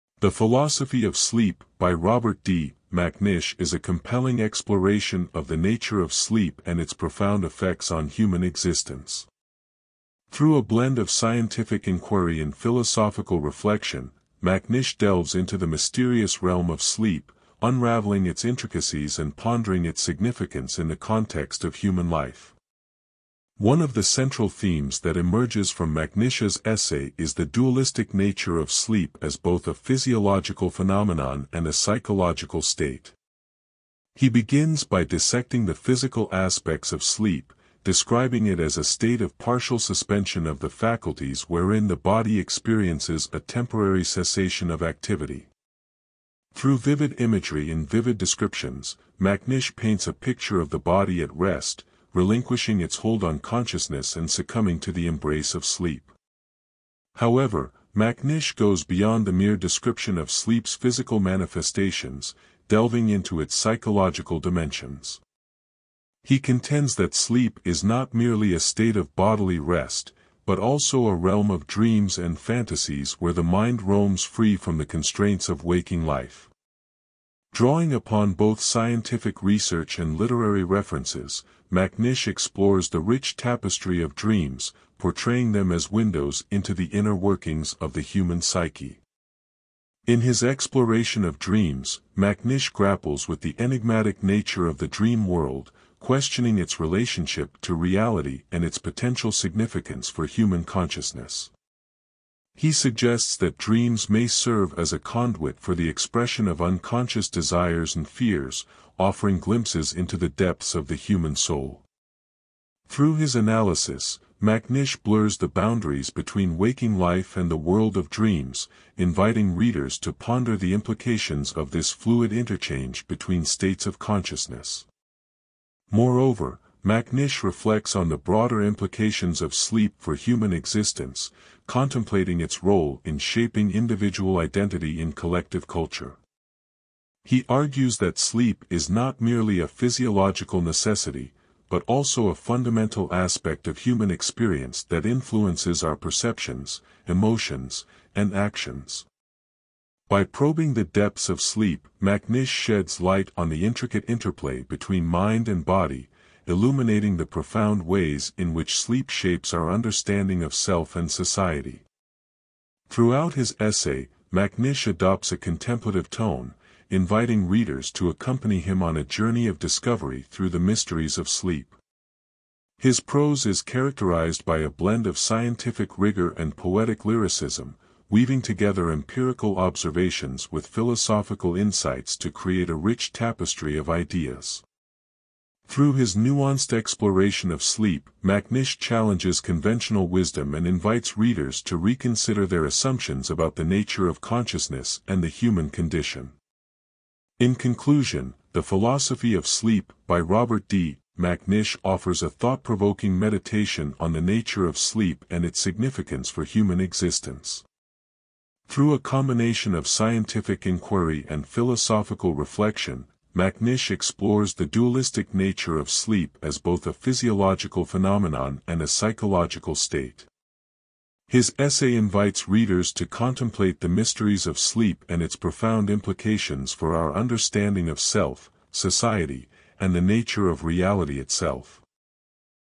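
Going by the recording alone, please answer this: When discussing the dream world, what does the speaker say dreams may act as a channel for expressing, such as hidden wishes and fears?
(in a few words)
unconscious desires.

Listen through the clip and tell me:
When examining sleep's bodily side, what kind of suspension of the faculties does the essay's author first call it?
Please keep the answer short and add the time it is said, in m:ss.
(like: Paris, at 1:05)
partial suspension, at 0:39.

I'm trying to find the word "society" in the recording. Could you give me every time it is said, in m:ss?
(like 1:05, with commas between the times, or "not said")
2:41, 3:48.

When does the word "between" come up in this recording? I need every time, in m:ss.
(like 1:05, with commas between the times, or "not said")
1:56, 2:03, 2:34.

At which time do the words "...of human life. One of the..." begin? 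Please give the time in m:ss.
0:21.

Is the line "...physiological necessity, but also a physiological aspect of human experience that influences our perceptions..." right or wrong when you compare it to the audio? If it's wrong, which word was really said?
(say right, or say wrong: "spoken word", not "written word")
wrong: "fundamental", not "physiological".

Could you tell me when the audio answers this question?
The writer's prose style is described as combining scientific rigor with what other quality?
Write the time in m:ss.
2:56.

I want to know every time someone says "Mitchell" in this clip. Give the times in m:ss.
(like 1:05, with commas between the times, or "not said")
not said.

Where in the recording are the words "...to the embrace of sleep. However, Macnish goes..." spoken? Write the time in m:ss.
0:54.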